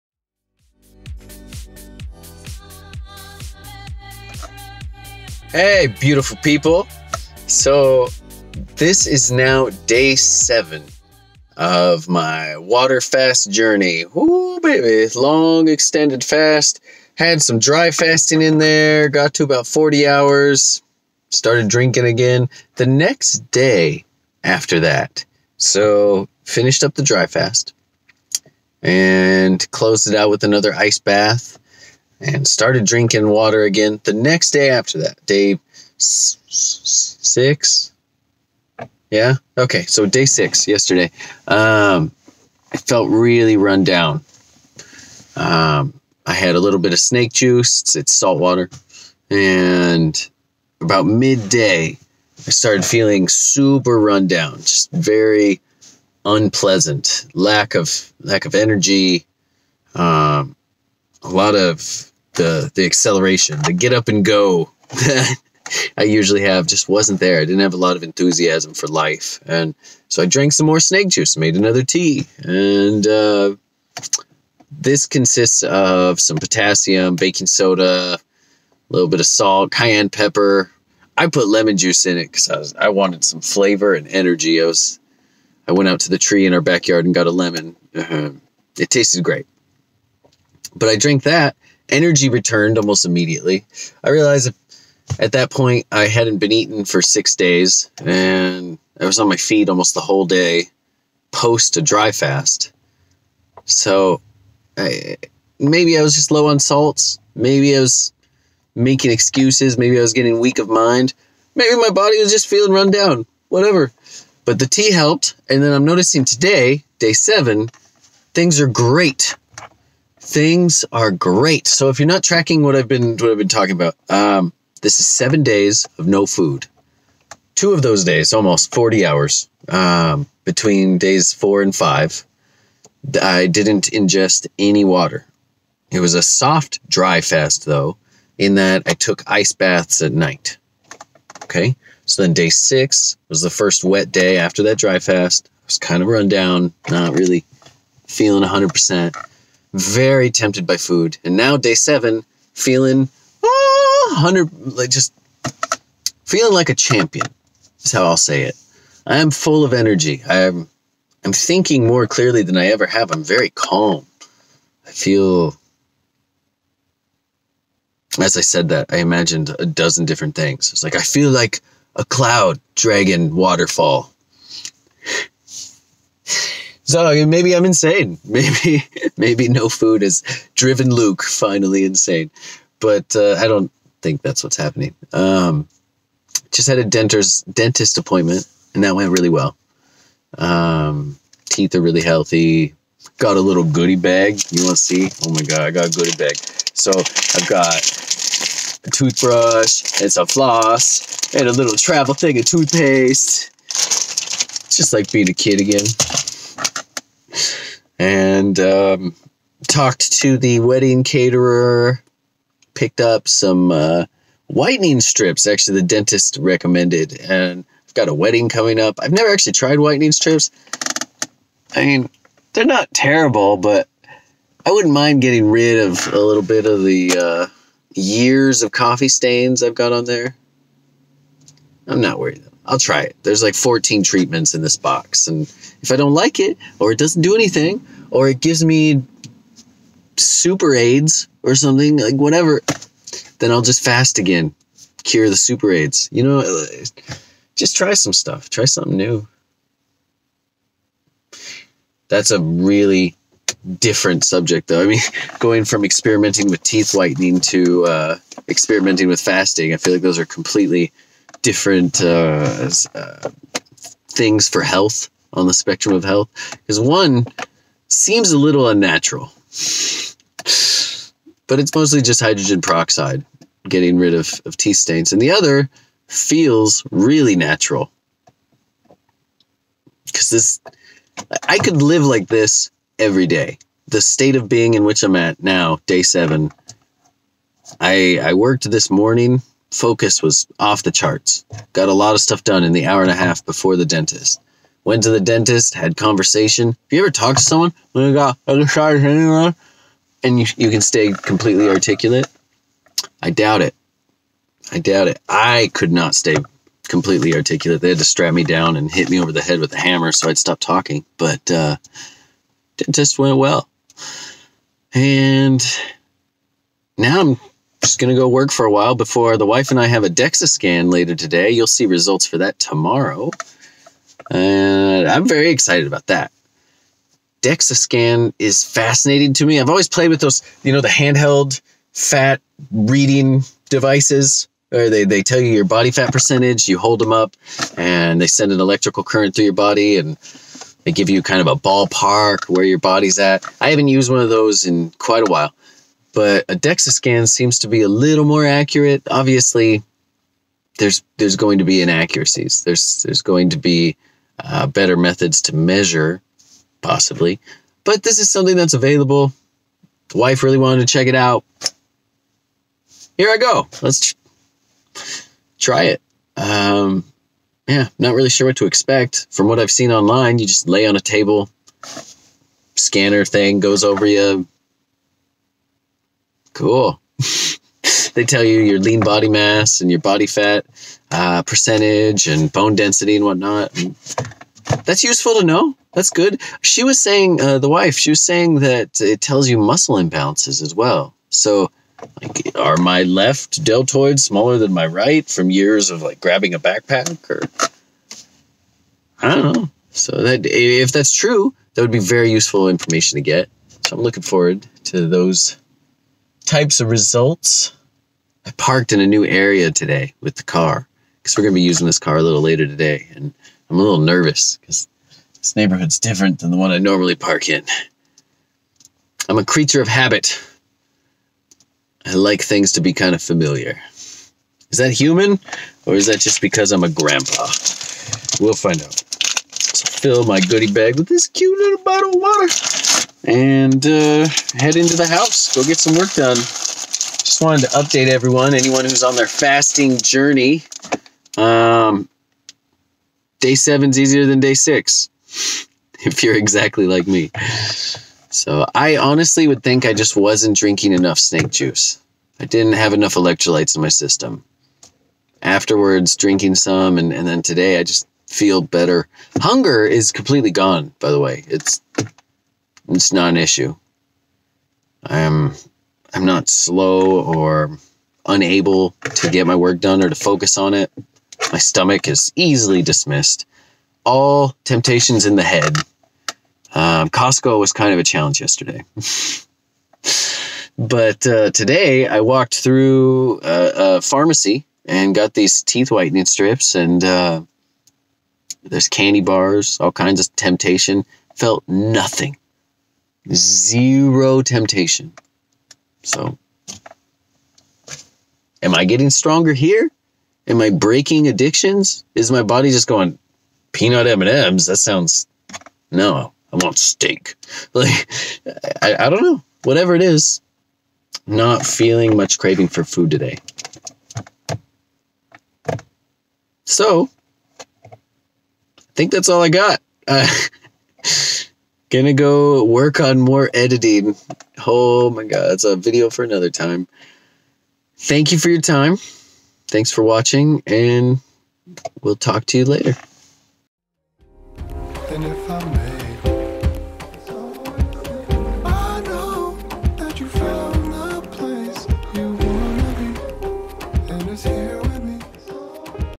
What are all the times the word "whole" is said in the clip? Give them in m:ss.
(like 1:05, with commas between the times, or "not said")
1:40.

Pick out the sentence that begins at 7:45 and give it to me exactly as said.
I'm I'm not slow or unable to get my work done or to focus on it.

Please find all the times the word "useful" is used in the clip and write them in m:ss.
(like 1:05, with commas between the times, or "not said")
6:25, 6:42.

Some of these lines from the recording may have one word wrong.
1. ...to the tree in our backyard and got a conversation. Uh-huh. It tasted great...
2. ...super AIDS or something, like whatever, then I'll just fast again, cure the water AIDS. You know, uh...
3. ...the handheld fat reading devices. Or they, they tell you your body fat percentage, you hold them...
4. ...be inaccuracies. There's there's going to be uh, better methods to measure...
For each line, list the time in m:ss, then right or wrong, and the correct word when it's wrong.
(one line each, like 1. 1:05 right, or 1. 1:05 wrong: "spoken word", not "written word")
1. 1:26 wrong: "lemon", not "conversation"
2. 4:00 wrong: "super", not "water"
3. 5:30 right
4. 5:51 right.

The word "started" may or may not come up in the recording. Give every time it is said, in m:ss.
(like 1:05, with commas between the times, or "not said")
0:21, 0:32, 0:52.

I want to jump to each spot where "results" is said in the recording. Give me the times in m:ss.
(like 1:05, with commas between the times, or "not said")
5:21, 6:46.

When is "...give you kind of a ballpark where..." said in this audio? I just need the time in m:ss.
5:40.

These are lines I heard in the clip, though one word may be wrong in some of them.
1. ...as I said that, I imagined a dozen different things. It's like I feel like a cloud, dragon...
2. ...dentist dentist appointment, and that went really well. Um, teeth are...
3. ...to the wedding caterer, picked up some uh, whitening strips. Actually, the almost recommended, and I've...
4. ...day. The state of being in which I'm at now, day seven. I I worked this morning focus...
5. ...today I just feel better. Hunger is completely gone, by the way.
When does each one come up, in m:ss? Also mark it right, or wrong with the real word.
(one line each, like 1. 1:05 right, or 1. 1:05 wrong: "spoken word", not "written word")
1. 2:48 right
2. 3:06 right
3. 3:30 wrong: "dentist", not "almost"
4. 4:43 right
5. 7:37 right.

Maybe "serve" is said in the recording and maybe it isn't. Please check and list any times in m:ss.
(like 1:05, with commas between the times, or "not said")
not said.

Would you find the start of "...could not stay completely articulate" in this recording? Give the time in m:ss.
5:05.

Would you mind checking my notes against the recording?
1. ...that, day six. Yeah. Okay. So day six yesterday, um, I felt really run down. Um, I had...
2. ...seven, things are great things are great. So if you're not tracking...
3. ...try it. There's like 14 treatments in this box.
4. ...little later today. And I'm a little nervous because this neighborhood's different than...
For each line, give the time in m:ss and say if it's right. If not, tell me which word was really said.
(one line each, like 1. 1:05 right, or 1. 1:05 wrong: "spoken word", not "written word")
1. 0:34 right
2. 1:57 right
3. 3:52 right
4. 6:52 right.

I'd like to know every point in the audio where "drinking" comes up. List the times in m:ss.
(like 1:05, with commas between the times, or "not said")
0:21, 0:32, 7:30, 7:36.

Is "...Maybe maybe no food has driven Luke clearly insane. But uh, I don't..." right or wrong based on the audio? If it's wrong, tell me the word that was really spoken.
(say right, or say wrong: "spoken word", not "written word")
wrong: "finally", not "clearly".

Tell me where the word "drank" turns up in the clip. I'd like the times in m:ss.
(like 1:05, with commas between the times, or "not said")
1:10, 1:30.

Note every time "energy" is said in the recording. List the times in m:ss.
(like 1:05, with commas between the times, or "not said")
0:58, 1:24, 1:31, 2:39.